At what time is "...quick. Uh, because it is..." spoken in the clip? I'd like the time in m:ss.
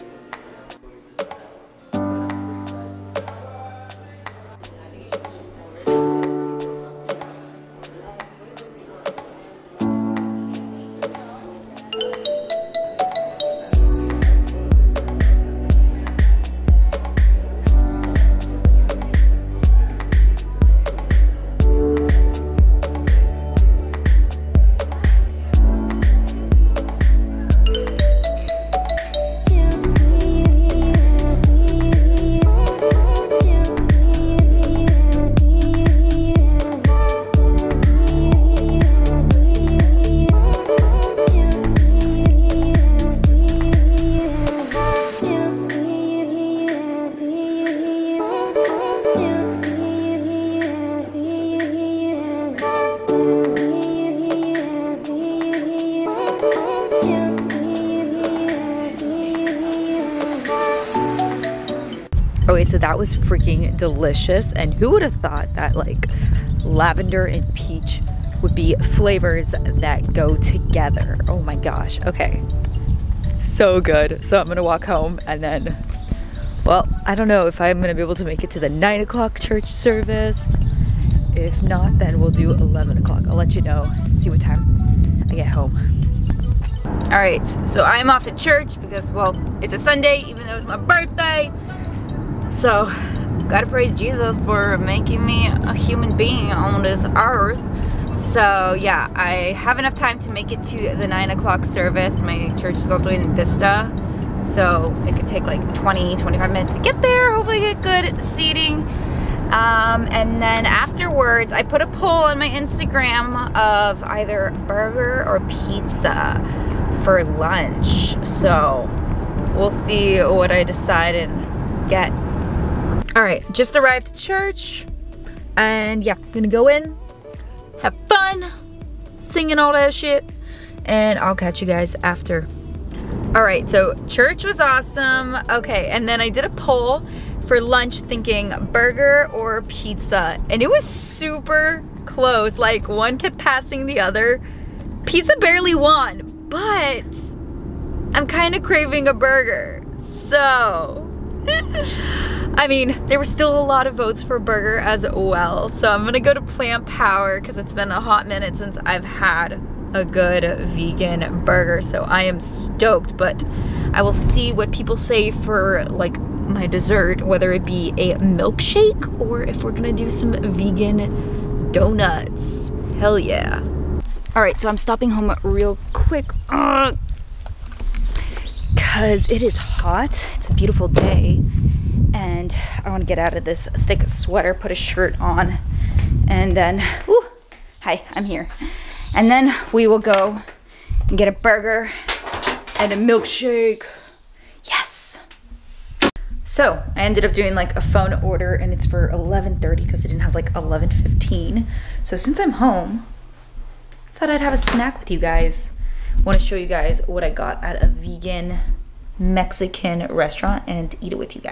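2:55.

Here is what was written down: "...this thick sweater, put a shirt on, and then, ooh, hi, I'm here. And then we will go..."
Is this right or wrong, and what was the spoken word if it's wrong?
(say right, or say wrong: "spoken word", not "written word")
right.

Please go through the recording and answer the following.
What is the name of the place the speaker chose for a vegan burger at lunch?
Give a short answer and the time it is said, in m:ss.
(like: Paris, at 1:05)
Plant Power, at 2:36.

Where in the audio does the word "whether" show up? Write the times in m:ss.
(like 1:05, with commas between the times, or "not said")
2:47.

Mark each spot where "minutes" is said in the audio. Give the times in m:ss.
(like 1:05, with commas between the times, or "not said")
1:46, 2:38.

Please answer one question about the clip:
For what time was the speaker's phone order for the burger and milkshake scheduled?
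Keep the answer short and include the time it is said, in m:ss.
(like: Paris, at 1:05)
11:30, at 3:19.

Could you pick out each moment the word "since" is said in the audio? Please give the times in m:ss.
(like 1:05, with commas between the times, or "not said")
2:38, 3:22.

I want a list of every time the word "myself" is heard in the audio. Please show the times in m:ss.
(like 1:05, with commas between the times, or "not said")
not said.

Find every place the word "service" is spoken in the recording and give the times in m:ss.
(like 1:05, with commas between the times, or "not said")
1:19, 1:41.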